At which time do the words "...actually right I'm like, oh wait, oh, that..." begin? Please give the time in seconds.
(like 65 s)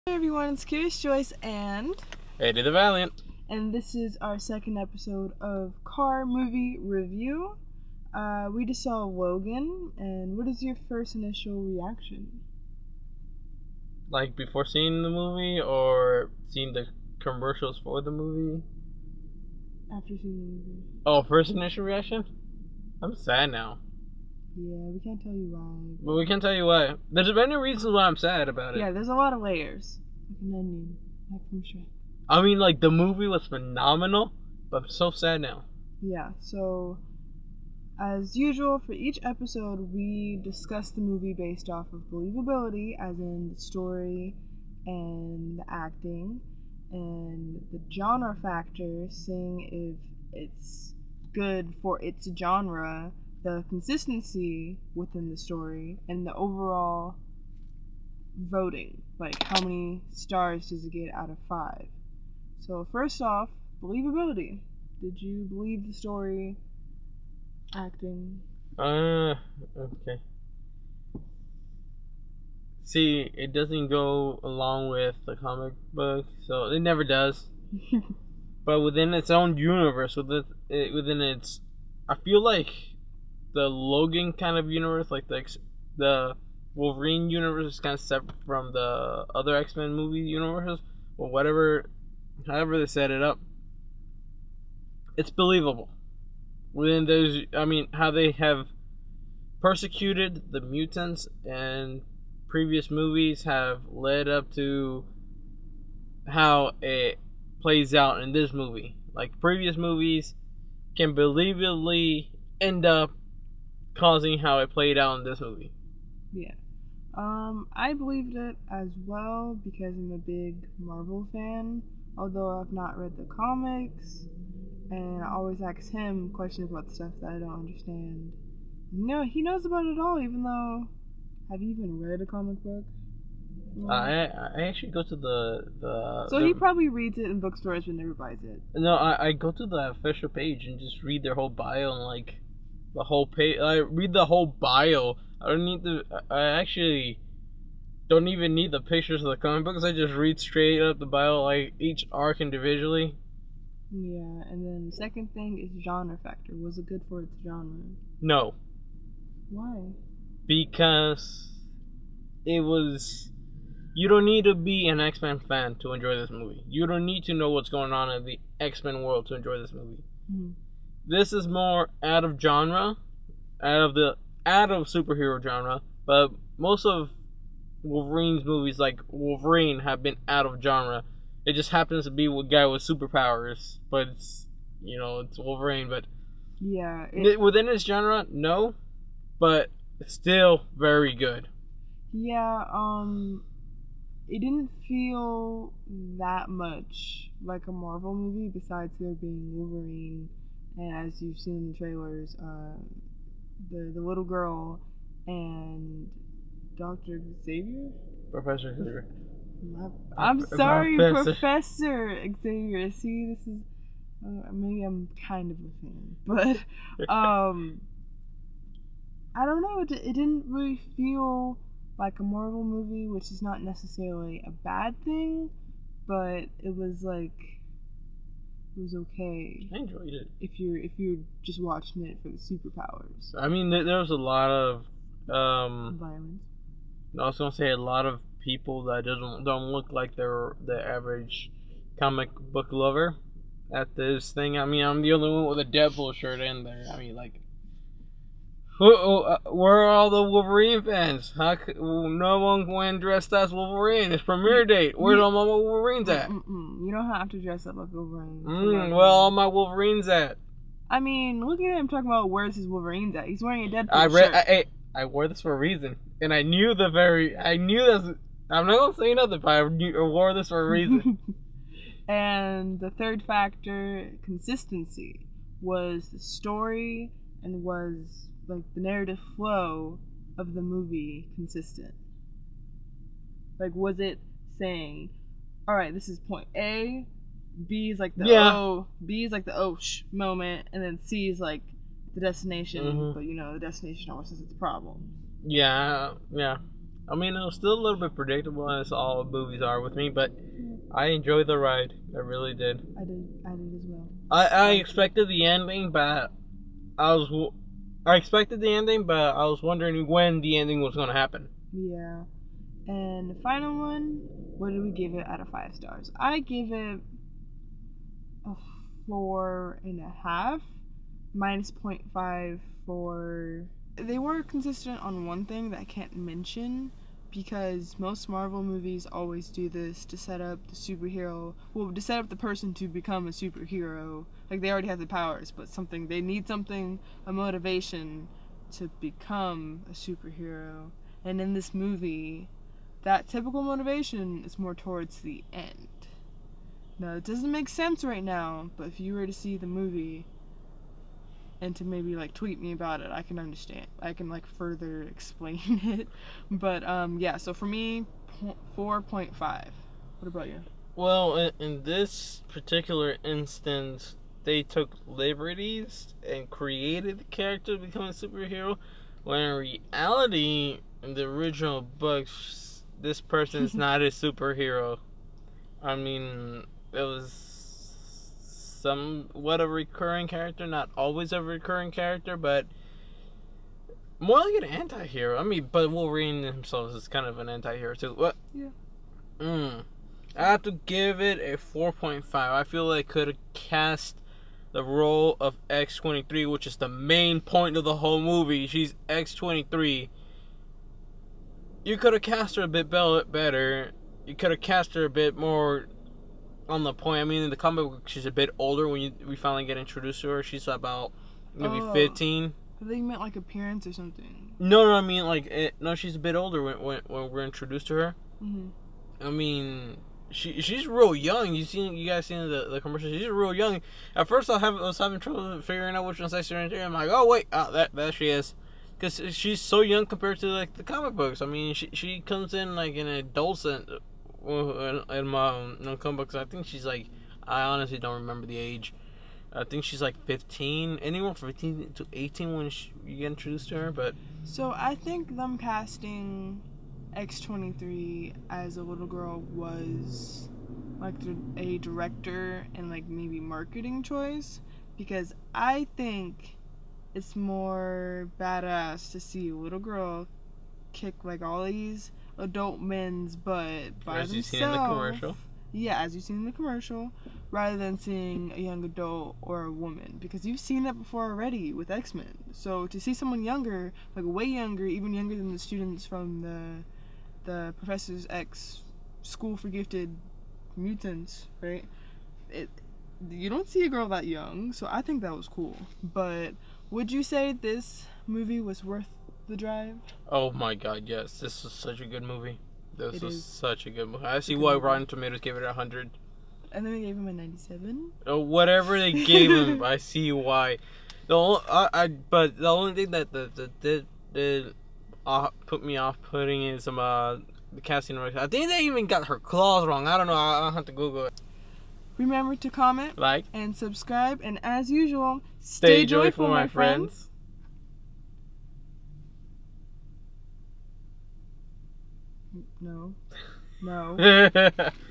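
426 s.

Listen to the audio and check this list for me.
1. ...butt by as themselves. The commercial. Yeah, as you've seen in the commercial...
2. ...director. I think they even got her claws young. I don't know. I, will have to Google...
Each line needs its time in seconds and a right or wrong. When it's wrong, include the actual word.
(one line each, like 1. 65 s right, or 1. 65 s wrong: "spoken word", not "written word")
1. 463 s right
2. 508 s wrong: "wrong", not "young".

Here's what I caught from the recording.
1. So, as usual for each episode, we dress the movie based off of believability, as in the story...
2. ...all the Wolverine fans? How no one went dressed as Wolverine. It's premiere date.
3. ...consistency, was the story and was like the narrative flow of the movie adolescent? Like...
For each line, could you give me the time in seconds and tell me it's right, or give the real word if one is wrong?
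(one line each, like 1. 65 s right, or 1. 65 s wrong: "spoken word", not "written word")
1. 36 s wrong: "discuss", not "dress"
2. 249 s right
3. 274 s wrong: "consistent", not "adolescent".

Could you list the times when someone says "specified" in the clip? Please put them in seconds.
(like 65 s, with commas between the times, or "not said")
not said.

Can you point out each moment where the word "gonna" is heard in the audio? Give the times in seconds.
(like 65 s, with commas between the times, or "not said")
237 s, 268 s.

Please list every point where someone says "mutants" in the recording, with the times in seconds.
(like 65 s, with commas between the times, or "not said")
100 s, 480 s.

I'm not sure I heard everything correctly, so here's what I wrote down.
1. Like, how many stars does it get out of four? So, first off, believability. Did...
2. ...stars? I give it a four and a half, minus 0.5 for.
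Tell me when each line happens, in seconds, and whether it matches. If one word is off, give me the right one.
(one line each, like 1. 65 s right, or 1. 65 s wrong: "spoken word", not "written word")
1. 59 s wrong: "five", not "four"
2. 315 s right.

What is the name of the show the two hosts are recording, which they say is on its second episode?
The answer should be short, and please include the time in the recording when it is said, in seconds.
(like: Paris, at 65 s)
Car Movie Review, at 5 s.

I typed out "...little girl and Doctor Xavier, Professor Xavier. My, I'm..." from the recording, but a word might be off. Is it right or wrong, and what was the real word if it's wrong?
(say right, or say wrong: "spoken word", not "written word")
right.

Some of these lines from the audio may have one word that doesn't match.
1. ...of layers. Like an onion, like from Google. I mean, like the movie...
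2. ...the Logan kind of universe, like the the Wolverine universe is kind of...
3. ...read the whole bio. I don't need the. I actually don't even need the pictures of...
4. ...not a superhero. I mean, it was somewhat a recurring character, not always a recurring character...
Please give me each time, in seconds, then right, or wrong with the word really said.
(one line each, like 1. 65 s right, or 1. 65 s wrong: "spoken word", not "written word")
1. 29 s wrong: "Shrek", not "Google"
2. 83 s right
3. 143 s right
4. 373 s right.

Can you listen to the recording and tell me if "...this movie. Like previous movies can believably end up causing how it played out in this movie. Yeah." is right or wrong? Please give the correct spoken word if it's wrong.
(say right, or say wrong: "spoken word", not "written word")
right.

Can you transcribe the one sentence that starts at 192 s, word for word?
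Yeah, um, it didn't feel that much like a Marvel movie.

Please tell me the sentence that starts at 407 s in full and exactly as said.
I mean, in the comic book, she's a bit older when you, we finally get introduced to her.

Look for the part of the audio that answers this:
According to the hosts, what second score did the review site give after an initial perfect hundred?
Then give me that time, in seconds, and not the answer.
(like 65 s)
497 s.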